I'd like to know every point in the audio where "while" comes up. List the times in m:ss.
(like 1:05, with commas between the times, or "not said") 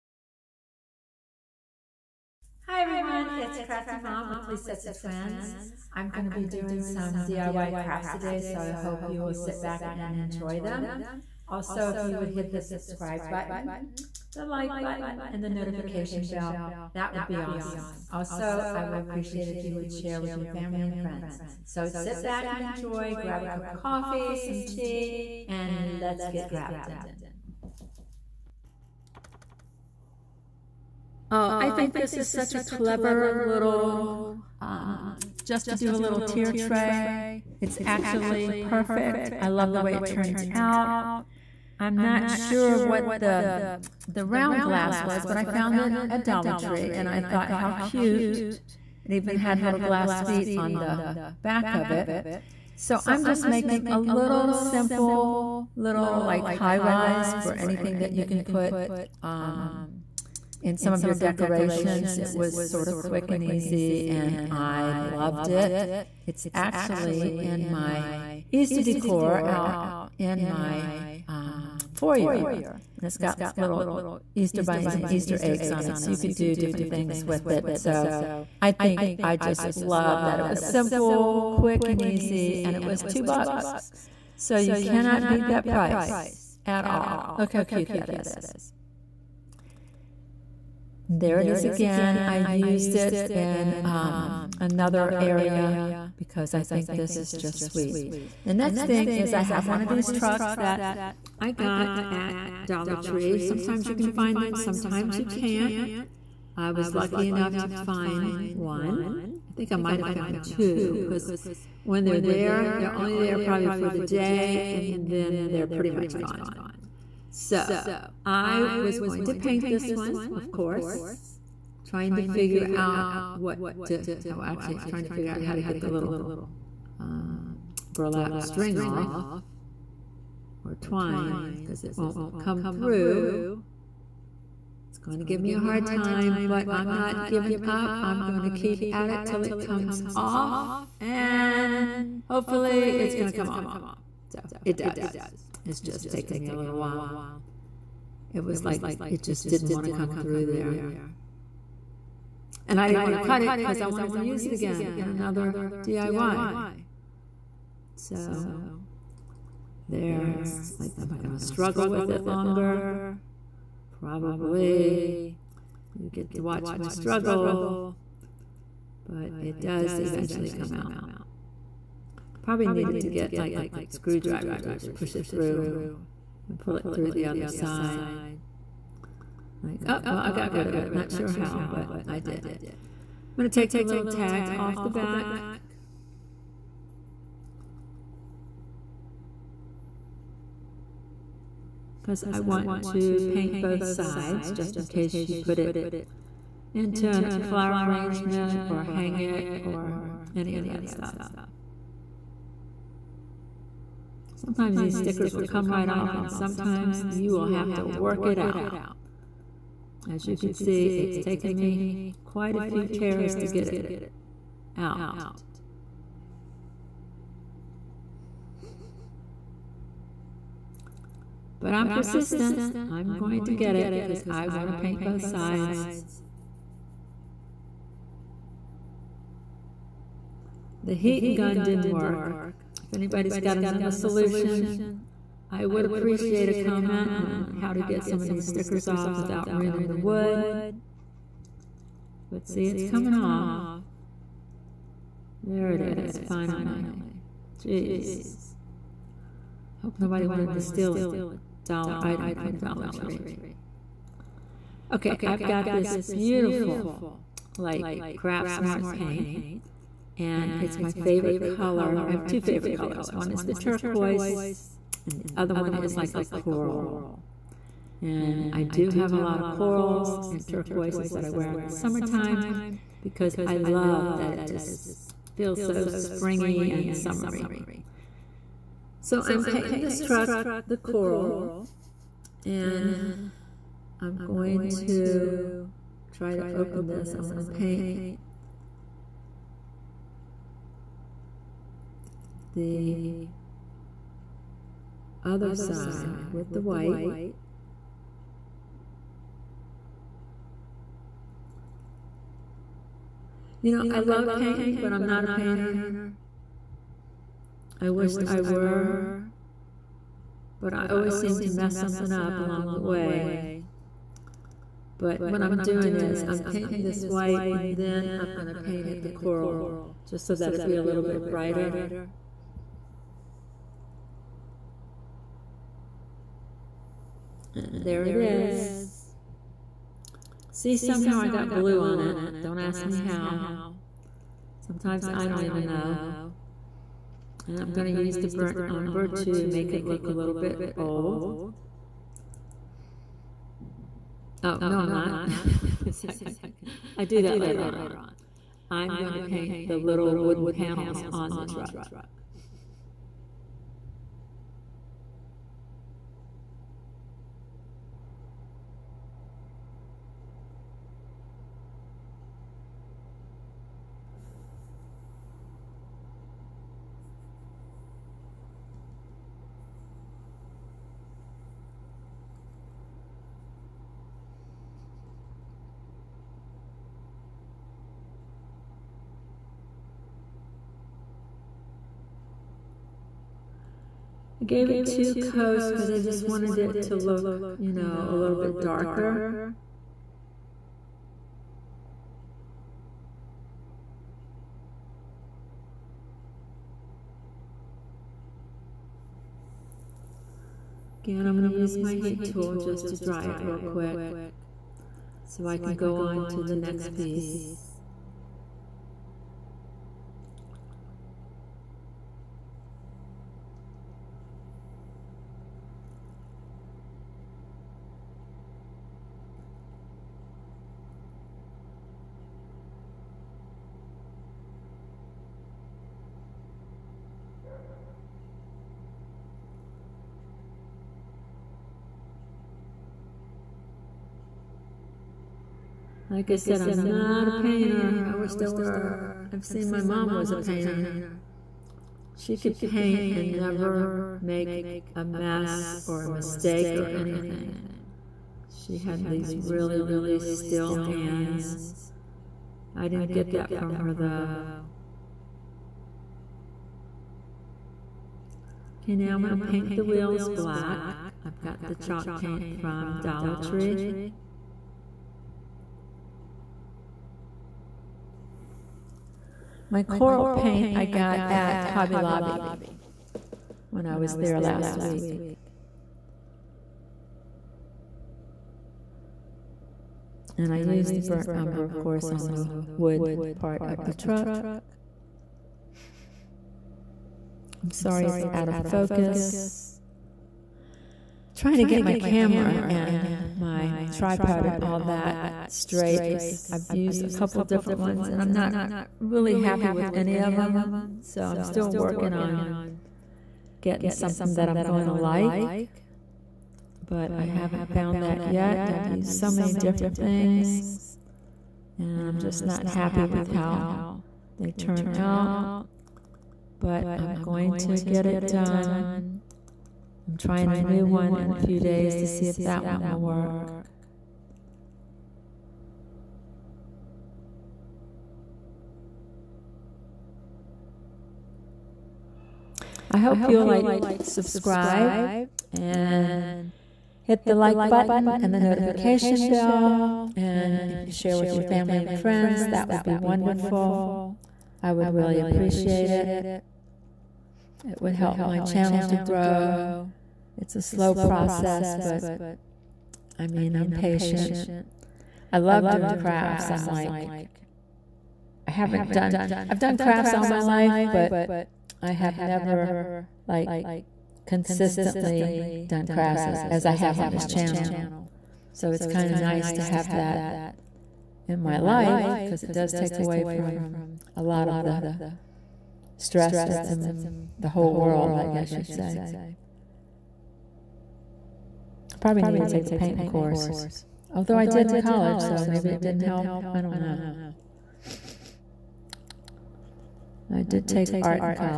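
2:26.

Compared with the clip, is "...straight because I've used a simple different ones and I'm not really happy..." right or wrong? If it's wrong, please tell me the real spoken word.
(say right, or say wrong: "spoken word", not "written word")
wrong: "couple", not "simple".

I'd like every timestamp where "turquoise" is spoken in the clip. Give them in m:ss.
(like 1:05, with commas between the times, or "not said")
4:23, 4:30.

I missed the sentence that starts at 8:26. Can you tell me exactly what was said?
But I haven't found that yet.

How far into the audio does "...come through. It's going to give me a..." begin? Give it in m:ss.
2:12.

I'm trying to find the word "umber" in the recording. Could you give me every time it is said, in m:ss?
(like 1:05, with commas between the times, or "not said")
5:38, 8:01.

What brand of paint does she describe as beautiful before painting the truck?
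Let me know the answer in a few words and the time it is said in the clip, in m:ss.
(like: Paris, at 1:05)
Craft Smart, at 4:18.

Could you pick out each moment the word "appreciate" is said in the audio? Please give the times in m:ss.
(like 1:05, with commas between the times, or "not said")
0:18, 3:55, 9:05.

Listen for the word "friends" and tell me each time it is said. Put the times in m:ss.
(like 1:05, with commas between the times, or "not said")
0:20, 9:01.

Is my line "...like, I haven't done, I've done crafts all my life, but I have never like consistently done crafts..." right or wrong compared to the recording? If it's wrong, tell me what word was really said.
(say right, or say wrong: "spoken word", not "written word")
right.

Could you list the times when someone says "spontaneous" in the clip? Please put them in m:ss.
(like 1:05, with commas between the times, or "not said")
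not said.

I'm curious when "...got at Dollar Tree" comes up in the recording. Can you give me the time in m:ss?
1:41.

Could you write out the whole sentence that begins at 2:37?
So there, it's like, am I going to struggle with it longer?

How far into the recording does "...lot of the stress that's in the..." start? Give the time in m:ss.
9:34.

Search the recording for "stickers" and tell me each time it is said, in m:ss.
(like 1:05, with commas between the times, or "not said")
3:24, 3:58.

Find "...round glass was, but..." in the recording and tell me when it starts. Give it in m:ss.
0:44.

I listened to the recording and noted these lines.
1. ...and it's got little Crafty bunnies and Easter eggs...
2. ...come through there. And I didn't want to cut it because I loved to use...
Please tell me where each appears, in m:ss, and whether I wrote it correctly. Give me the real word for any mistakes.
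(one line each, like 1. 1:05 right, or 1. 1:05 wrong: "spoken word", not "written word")
1. 1:12 wrong: "Easter", not "Crafty"
2. 2:29 wrong: "wanted", not "loved".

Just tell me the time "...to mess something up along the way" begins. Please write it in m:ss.
5:11.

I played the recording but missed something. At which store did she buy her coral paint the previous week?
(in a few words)
Hobby Lobby.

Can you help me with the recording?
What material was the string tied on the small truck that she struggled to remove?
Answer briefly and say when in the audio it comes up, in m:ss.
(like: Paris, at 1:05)
Burlap, at 2:07.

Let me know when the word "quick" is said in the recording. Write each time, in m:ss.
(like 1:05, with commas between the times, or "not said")
1:02, 1:21, 6:43.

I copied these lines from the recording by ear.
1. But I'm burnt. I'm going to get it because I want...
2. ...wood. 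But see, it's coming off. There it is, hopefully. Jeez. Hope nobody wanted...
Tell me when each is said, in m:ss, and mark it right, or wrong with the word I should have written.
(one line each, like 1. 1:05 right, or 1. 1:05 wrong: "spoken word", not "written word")
1. 3:41 wrong: "persistent", not "burnt"
2. 3:59 wrong: "finally", not "hopefully".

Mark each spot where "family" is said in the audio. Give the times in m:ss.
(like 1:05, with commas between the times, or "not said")
0:20, 9:01.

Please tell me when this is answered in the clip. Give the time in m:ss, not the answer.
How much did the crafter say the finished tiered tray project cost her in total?
1:23.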